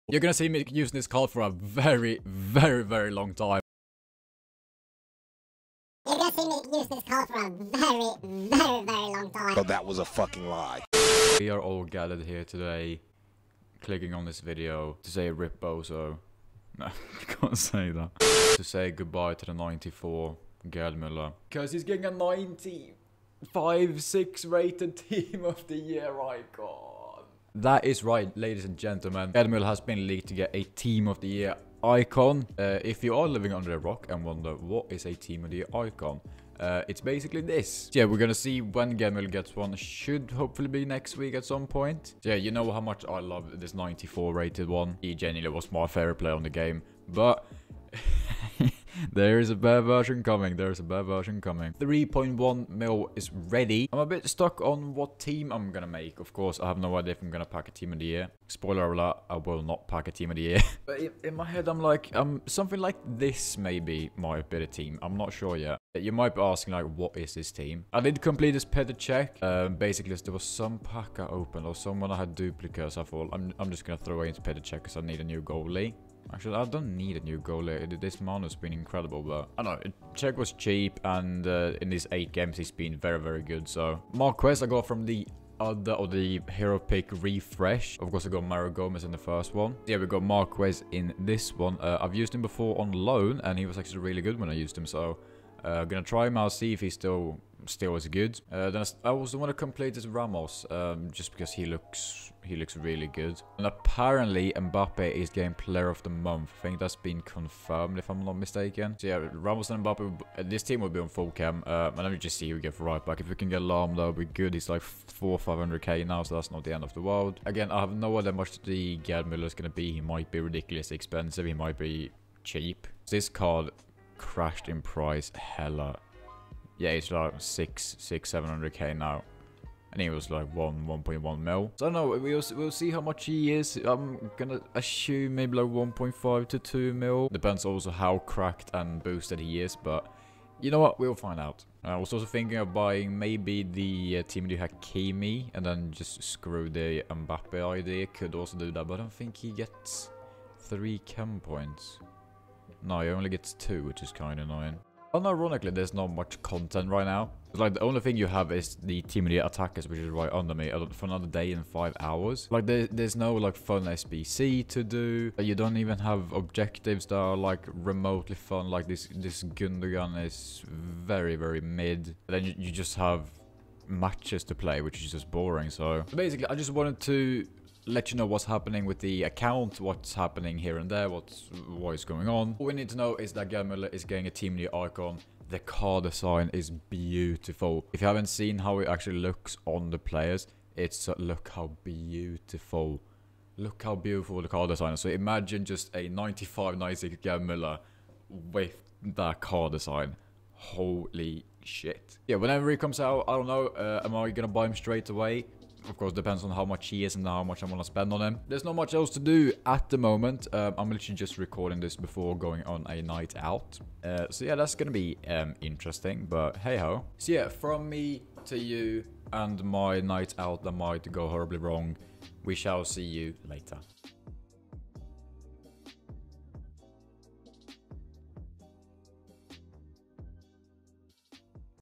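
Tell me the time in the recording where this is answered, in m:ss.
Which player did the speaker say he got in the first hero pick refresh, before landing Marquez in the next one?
1:28.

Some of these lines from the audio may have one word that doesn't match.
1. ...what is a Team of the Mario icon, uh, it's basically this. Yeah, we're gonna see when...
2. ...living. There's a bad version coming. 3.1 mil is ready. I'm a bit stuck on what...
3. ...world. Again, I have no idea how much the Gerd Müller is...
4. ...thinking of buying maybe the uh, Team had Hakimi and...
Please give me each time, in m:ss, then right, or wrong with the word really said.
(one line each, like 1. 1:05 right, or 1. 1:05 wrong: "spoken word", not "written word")
1. 0:34 wrong: "Year", not "Mario"
2. 0:50 wrong: "coming", not "living"
3. 1:57 right
4. 2:22 right.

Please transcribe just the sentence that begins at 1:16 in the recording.
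Actually, I don't need a new goalie.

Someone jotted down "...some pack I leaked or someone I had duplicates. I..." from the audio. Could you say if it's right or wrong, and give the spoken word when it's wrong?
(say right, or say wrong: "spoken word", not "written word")
wrong: "opened", not "leaked".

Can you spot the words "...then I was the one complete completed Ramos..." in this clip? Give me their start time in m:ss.
1:38.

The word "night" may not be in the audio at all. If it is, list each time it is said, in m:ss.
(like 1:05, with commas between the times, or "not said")
3:33, 3:40.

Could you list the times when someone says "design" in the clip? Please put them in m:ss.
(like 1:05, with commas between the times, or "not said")
3:06, 3:14, 3:19.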